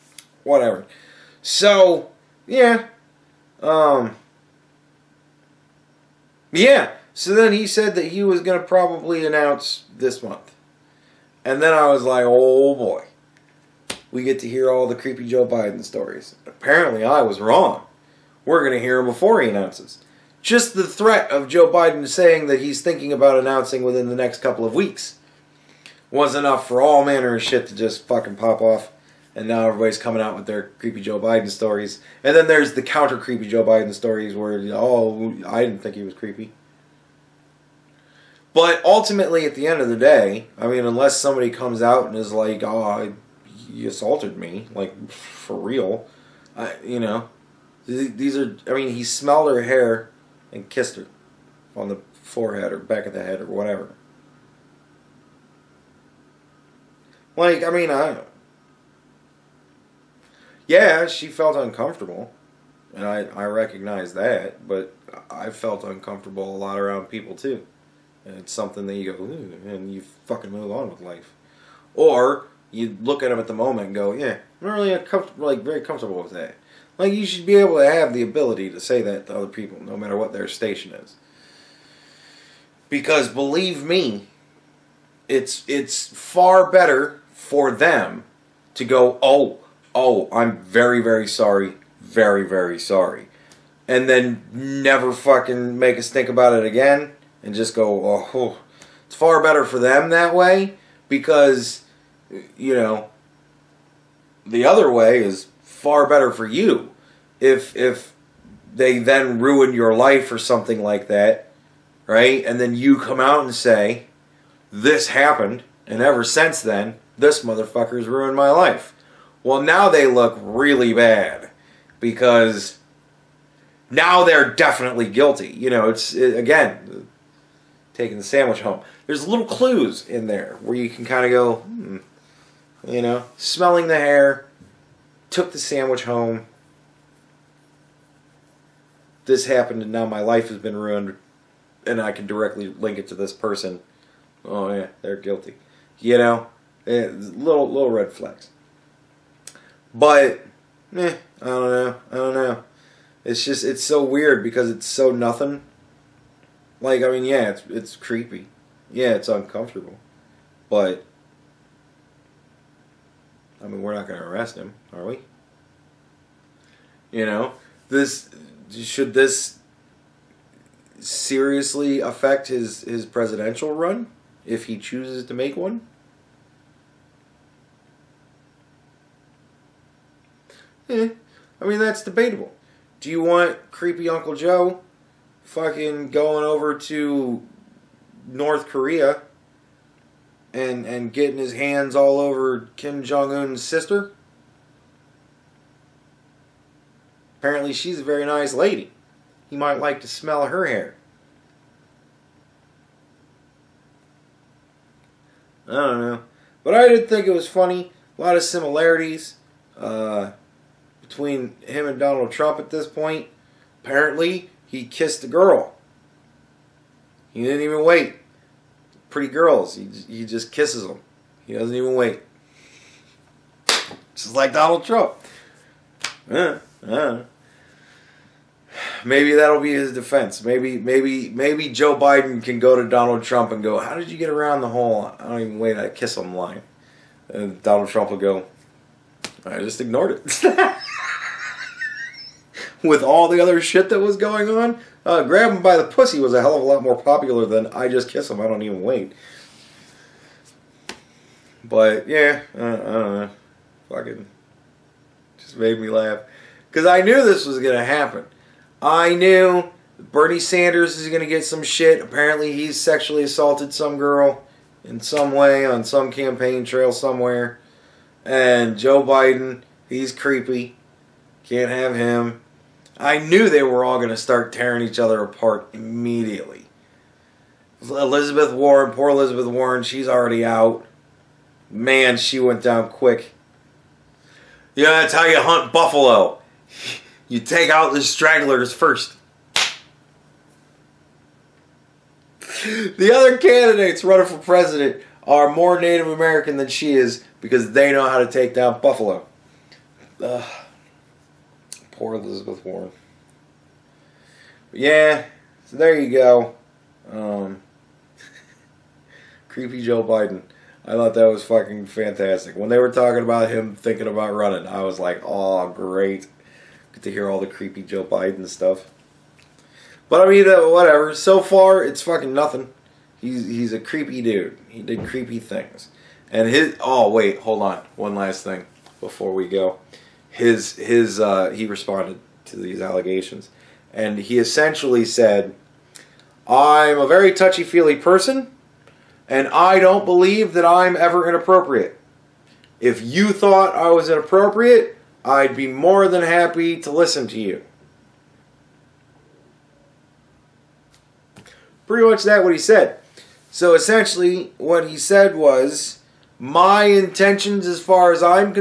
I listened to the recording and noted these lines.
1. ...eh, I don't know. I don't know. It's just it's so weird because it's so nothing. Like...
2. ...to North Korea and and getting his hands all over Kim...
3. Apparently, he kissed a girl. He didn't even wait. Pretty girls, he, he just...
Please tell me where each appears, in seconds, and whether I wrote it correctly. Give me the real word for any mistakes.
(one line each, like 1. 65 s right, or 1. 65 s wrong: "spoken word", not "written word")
1. 150 s right
2. 186 s right
3. 213 s right.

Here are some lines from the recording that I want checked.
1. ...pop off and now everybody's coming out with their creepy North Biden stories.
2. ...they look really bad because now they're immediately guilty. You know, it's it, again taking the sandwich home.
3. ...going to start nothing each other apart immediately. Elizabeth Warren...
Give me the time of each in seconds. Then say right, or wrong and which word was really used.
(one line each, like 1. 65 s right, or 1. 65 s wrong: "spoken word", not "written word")
1. 28 s wrong: "Joe", not "North"
2. 119 s wrong: "definitely", not "immediately"
3. 273 s wrong: "tearing", not "nothing".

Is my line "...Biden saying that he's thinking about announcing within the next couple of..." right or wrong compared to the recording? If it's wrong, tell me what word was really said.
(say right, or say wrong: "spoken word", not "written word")
right.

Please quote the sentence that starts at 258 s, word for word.
I knew Bernie Sanders is gonna get some shit.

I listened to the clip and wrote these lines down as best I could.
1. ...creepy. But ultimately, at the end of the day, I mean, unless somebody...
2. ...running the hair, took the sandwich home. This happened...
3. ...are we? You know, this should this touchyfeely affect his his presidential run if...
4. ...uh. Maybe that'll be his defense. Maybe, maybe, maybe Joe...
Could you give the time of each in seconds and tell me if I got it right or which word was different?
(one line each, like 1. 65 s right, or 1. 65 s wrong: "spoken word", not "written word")
1. 36 s right
2. 133 s wrong: "smelling", not "running"
3. 164 s wrong: "seriously", not "touchyfeely"
4. 226 s right.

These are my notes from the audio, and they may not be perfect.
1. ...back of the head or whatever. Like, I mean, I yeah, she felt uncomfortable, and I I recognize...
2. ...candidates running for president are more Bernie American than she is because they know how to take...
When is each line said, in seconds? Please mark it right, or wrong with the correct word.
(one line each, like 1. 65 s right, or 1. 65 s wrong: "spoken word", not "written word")
1. 52 s right
2. 293 s wrong: "Native", not "Bernie".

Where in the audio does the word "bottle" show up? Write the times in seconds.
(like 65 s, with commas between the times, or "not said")
not said.